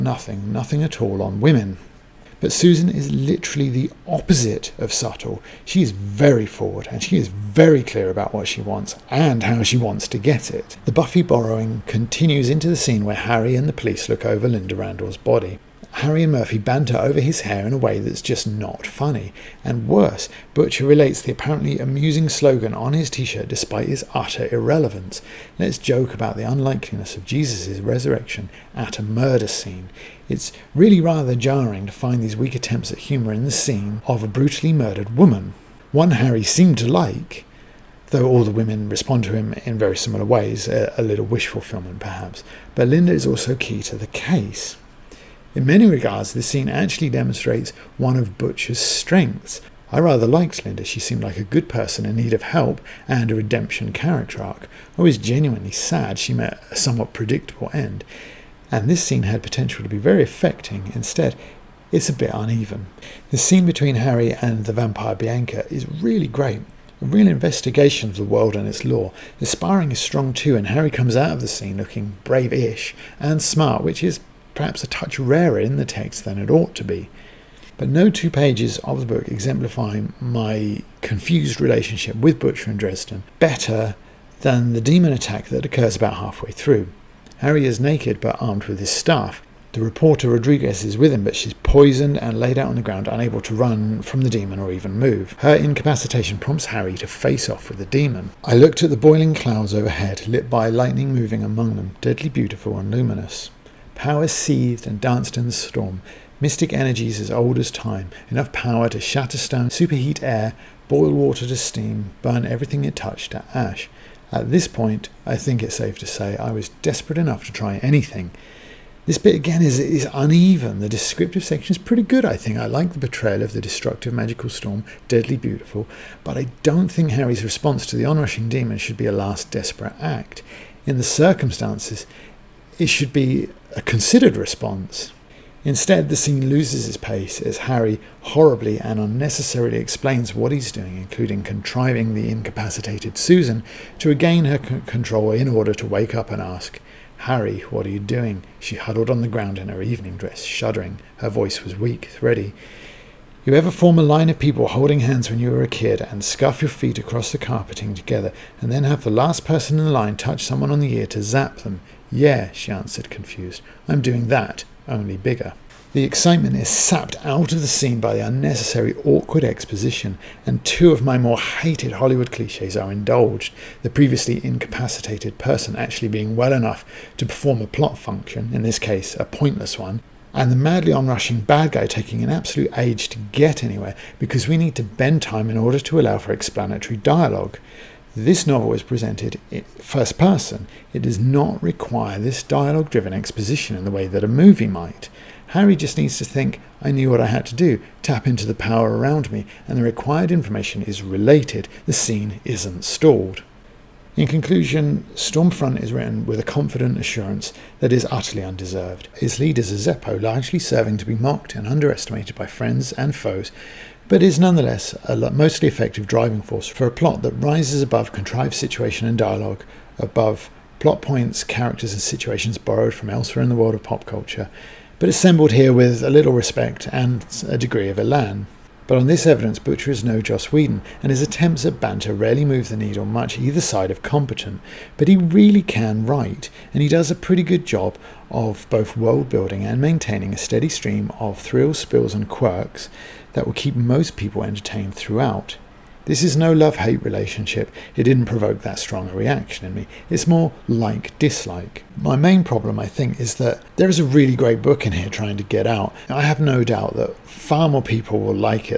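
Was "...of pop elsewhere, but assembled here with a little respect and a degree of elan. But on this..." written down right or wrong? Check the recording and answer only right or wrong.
wrong.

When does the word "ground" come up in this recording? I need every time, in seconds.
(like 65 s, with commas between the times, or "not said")
92 s, 149 s.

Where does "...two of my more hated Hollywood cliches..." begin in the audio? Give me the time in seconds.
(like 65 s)
170 s.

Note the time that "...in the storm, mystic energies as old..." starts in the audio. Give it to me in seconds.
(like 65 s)
105 s.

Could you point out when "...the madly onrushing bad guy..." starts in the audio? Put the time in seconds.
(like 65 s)
180 s.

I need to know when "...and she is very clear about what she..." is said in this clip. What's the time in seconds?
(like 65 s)
6 s.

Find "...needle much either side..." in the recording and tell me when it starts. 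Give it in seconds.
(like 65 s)
232 s.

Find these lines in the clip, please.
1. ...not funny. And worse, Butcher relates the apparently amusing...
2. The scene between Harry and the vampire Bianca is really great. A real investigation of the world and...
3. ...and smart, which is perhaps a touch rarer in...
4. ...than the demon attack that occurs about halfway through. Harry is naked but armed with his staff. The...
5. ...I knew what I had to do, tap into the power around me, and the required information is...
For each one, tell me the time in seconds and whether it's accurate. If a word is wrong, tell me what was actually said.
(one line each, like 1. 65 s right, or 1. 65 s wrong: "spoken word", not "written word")
1. 18 s right
2. 63 s right
3. 73 s right
4. 84 s right
5. 196 s right.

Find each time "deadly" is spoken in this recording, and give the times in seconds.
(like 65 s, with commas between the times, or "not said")
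102 s, 125 s.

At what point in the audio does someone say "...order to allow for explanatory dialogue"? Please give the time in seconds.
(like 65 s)
185 s.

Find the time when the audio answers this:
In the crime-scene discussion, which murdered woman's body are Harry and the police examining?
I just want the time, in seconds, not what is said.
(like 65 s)
14 s.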